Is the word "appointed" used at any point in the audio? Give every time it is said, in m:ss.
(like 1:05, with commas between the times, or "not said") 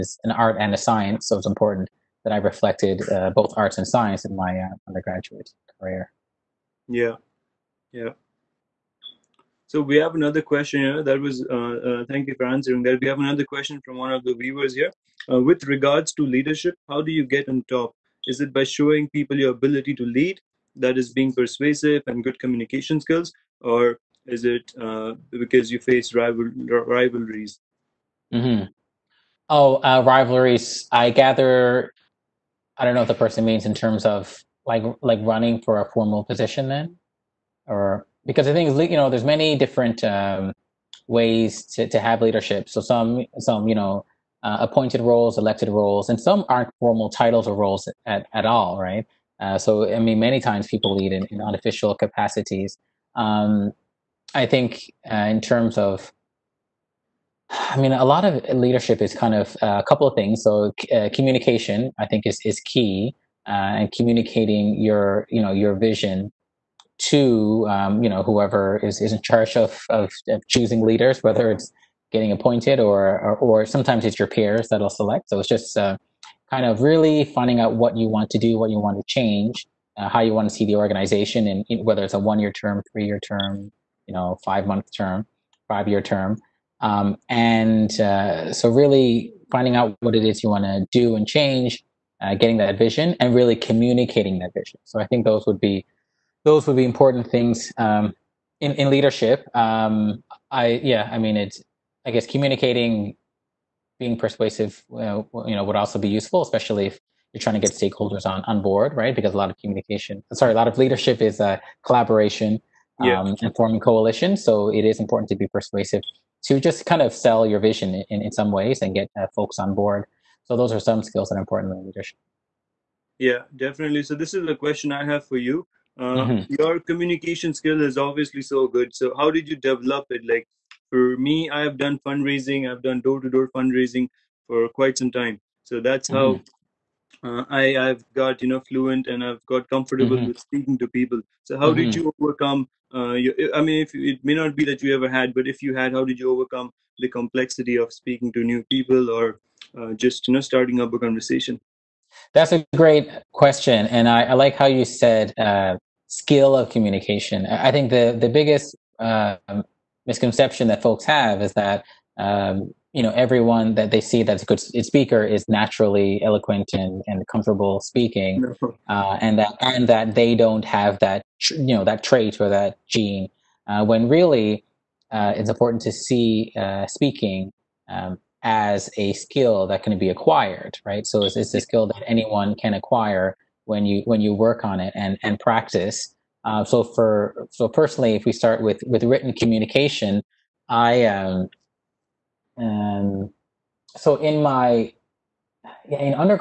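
0:44, 1:12.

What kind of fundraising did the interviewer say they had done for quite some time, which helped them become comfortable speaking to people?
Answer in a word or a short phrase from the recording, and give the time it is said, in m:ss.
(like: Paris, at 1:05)
door-to-door, at 2:13.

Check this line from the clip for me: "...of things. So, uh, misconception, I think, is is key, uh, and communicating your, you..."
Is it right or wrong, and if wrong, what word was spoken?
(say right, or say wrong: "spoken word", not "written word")
wrong: "communication", not "misconception".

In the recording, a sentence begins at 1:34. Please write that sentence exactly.
So I think those would be those would be important things um, in in leadership.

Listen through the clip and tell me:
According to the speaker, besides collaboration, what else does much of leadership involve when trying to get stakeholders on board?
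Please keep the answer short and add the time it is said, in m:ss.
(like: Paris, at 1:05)
forming coalitions, at 1:53.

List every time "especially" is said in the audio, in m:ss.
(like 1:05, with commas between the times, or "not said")
1:46.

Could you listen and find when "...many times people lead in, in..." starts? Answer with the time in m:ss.
0:50.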